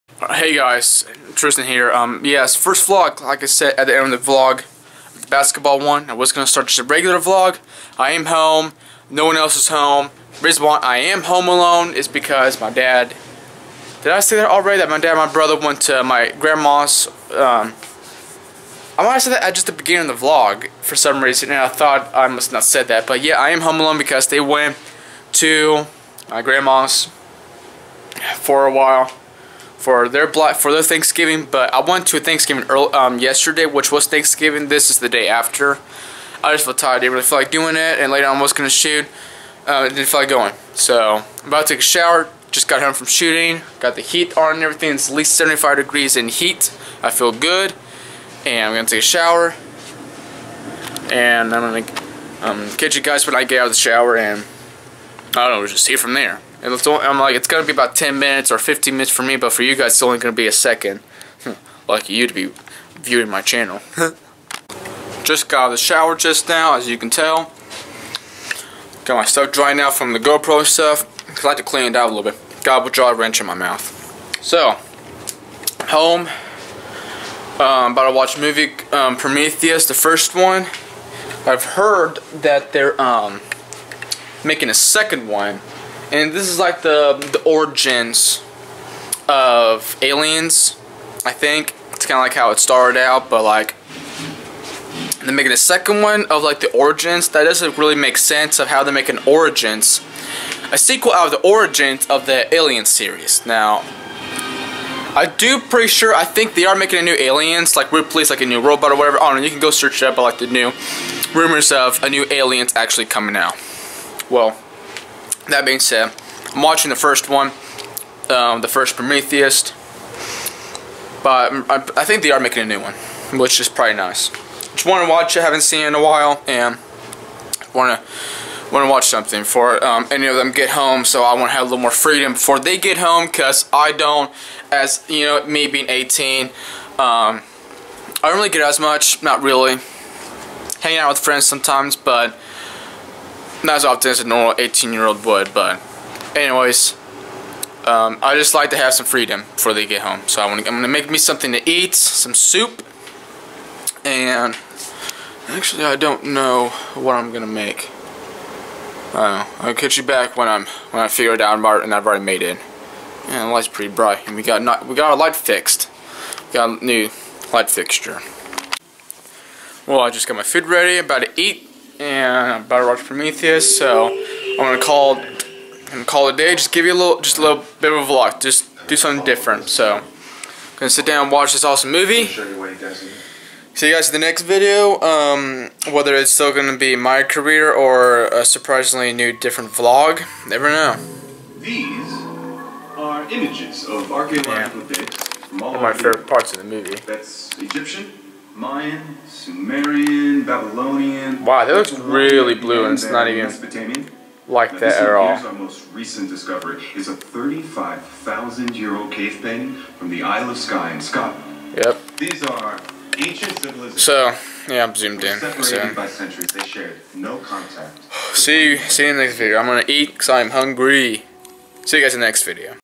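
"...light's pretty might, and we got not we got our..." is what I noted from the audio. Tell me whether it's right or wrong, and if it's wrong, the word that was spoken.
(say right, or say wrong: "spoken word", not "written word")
wrong: "bright", not "might".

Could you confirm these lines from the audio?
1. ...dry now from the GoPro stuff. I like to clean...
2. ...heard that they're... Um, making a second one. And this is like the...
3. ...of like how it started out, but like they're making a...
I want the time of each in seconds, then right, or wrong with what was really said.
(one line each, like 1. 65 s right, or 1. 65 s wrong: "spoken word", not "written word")
1. 69 s right
2. 81 s right
3. 92 s right.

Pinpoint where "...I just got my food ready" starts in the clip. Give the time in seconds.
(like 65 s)
169 s.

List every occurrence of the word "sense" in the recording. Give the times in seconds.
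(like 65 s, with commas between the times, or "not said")
98 s.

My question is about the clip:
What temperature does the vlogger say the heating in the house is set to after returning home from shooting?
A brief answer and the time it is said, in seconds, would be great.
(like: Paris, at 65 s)
75 degrees, at 45 s.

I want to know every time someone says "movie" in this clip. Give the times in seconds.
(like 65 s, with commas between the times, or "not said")
78 s, 181 s, 196 s.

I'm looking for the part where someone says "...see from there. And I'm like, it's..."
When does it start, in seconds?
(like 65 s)
55 s.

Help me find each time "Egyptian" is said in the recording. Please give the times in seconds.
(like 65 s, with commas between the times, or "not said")
197 s.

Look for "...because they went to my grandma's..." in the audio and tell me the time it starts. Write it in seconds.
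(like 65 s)
23 s.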